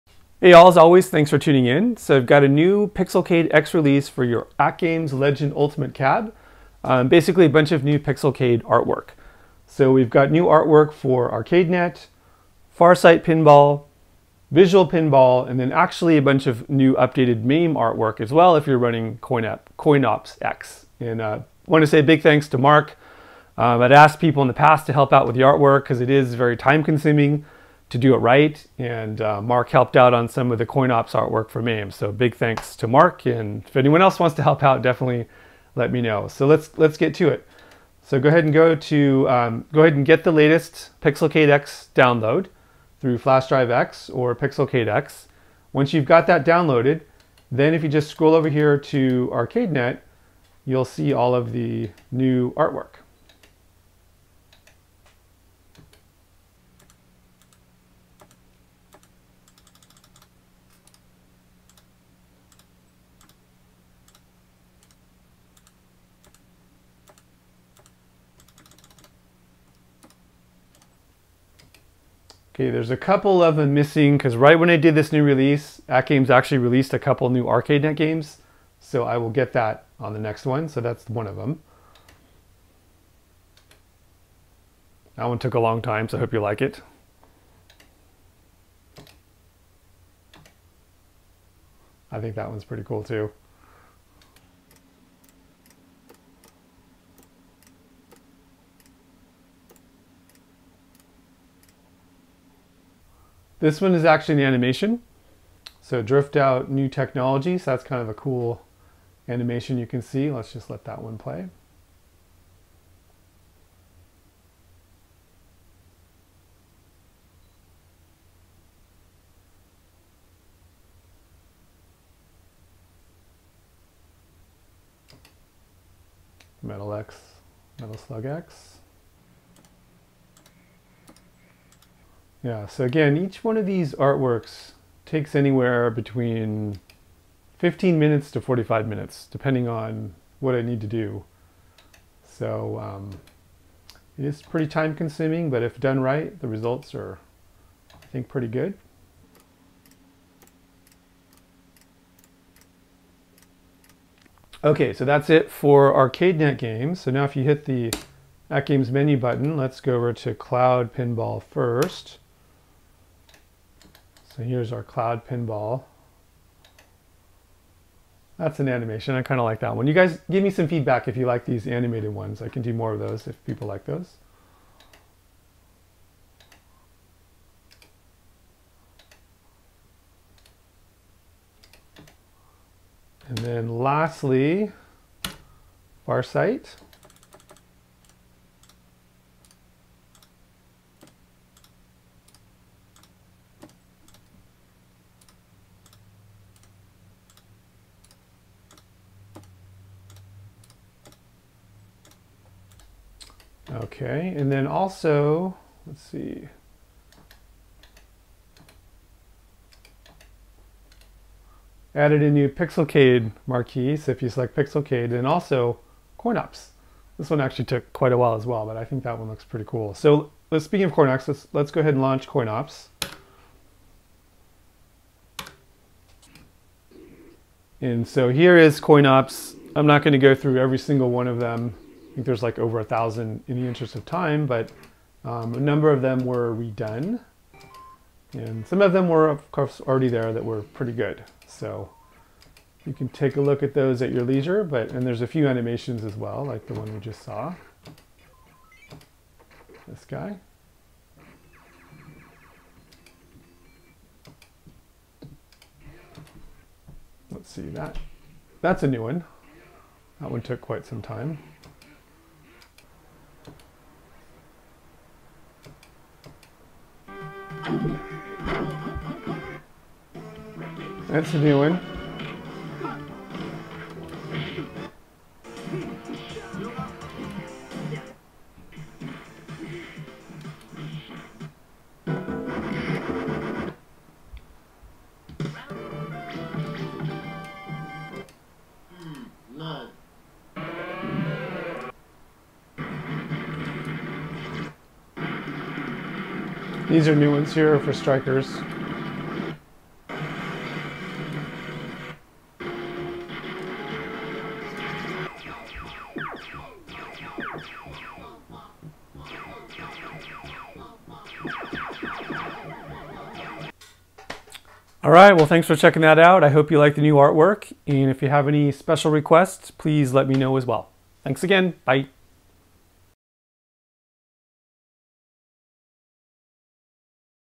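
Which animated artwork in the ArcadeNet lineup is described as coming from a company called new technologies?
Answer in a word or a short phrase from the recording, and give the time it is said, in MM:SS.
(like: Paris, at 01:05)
Drift Out, at 01:46.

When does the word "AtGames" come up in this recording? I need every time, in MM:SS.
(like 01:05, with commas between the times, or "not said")
00:04, 01:15, 02:38.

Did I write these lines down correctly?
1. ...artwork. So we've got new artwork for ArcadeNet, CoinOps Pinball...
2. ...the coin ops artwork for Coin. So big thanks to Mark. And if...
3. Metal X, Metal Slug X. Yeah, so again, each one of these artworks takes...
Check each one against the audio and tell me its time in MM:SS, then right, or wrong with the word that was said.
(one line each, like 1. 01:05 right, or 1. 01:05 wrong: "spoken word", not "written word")
1. 00:08 wrong: "Farsight", not "CoinOps"
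2. 00:30 wrong: "MAME", not "Coin"
3. 02:06 right.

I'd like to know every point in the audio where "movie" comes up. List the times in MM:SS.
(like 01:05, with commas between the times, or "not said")
not said.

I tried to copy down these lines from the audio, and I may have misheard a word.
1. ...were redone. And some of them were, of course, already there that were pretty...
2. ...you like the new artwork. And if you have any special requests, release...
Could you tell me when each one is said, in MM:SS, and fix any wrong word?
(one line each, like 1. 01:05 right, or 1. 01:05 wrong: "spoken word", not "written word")
1. 03:56 right
2. 05:16 wrong: "please", not "release".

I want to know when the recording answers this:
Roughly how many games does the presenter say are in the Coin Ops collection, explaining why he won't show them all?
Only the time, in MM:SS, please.
03:52.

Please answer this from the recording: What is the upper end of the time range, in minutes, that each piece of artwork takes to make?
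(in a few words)
45 minutes.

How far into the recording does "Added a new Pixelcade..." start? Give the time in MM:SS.
03:31.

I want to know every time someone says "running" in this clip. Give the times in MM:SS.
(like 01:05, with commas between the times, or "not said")
00:18.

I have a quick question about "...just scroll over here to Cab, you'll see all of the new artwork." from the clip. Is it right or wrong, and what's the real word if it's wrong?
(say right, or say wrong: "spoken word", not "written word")
wrong: "ArcadeNet", not "Cab".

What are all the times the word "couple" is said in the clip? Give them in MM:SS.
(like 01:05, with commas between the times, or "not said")
01:12, 01:16.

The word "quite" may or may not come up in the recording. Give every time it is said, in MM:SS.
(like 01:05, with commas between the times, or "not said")
03:37, 04:20.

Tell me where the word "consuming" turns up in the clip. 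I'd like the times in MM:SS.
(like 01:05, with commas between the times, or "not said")
00:26, 02:24.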